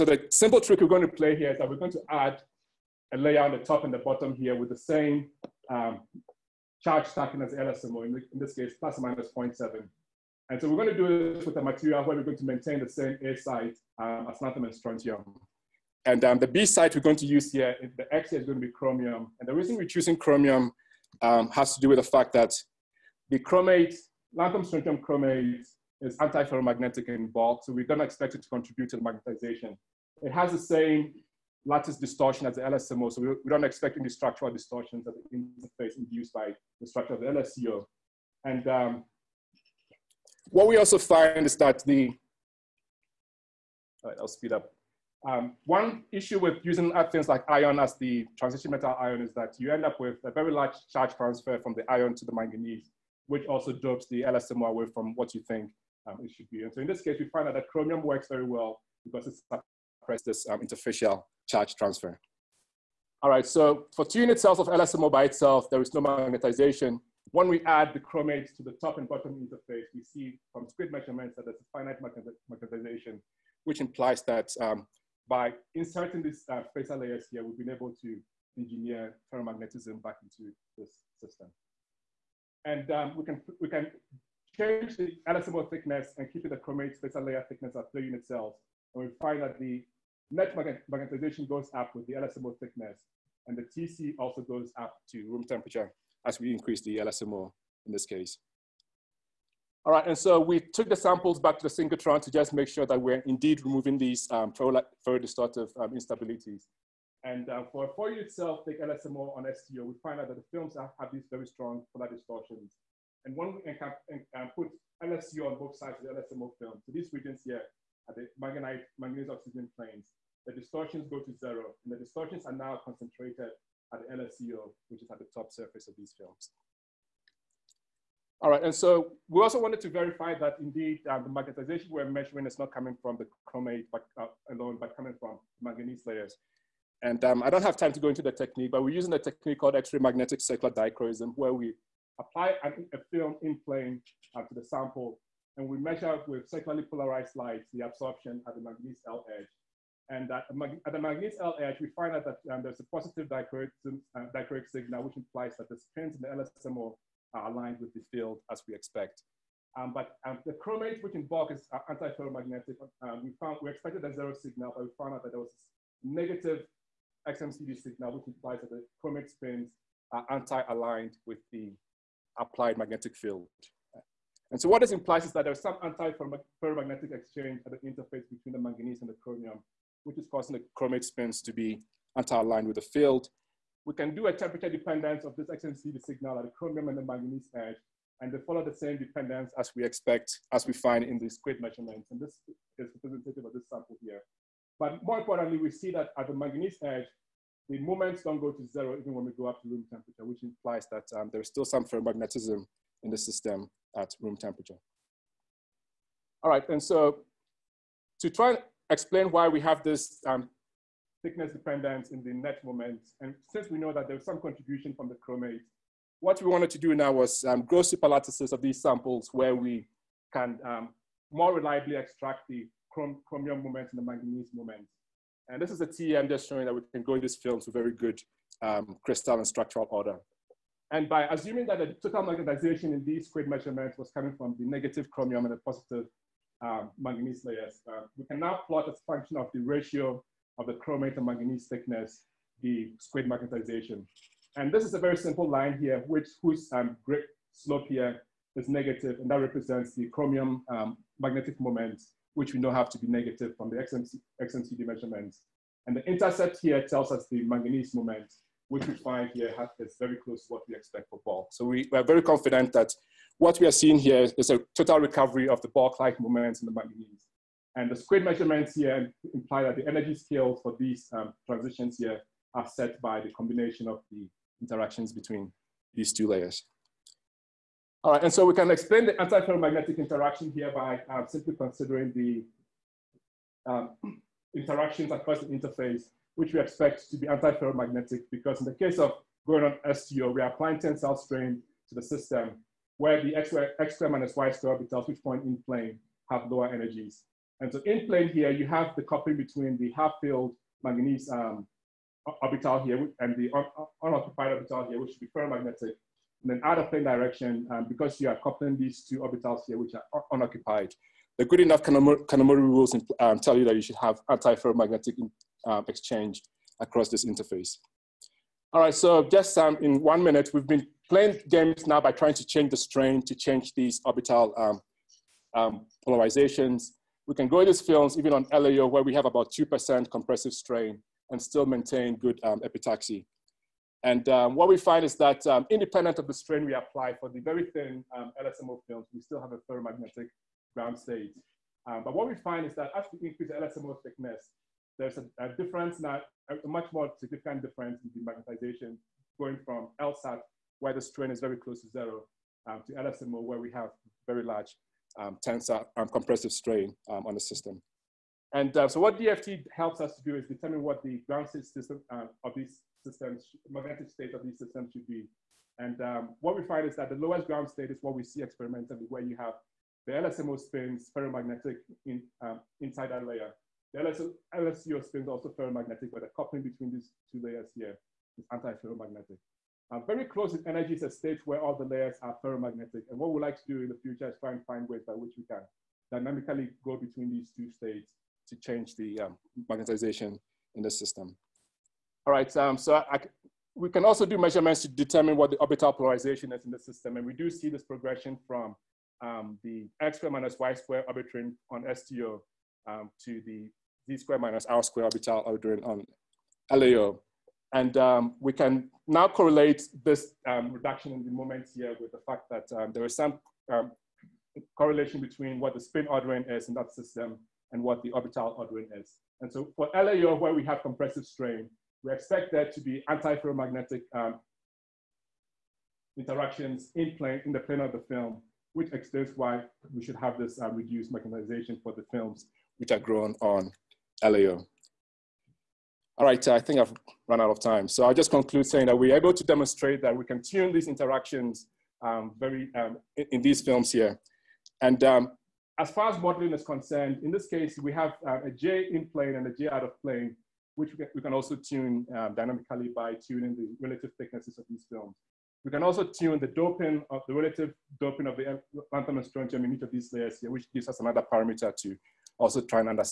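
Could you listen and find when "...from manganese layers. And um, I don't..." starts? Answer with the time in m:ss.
2:15.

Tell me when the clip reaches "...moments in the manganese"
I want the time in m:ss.
4:26.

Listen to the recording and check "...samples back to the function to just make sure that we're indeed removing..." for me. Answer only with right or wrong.
wrong.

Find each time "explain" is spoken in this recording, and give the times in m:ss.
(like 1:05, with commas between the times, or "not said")
3:28, 4:38, 7:08.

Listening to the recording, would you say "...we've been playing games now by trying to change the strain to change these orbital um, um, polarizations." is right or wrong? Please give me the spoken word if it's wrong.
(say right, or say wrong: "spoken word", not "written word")
right.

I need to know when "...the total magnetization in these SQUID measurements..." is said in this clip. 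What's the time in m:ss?
3:51.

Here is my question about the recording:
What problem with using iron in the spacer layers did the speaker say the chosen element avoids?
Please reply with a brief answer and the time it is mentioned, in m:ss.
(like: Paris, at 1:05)
Interfacial charge transfer, at 1:00.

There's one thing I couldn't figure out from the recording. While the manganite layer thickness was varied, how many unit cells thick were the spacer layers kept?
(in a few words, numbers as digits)
3.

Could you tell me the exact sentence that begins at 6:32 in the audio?
All right, um, so I, I, we can also do measurements to determine what the orbital polarization is in the system.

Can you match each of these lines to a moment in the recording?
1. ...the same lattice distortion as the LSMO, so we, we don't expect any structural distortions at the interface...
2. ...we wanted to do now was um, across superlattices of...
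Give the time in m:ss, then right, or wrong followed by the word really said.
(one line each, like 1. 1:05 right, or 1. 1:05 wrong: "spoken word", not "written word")
1. 0:30 right
2. 3:36 wrong: "gross", not "across".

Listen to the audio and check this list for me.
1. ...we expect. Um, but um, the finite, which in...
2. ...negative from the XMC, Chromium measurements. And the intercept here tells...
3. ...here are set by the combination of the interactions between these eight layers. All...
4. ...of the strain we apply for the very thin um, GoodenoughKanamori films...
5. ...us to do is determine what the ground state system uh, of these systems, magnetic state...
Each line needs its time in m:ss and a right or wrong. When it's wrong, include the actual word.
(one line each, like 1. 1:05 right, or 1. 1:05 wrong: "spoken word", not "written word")
1. 2:38 wrong: "chromate", not "finite"
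2. 4:13 wrong: "XMCD", not "Chromium"
3. 4:31 wrong: "two", not "eight"
4. 5:36 wrong: "LSMO", not "GoodenoughKanamori"
5. 6:00 right.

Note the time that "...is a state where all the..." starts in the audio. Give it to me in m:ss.
6:20.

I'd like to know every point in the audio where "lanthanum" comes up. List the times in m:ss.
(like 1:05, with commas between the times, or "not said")
0:14, 0:24, 7:38.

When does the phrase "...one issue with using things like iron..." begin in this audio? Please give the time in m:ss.
0:45.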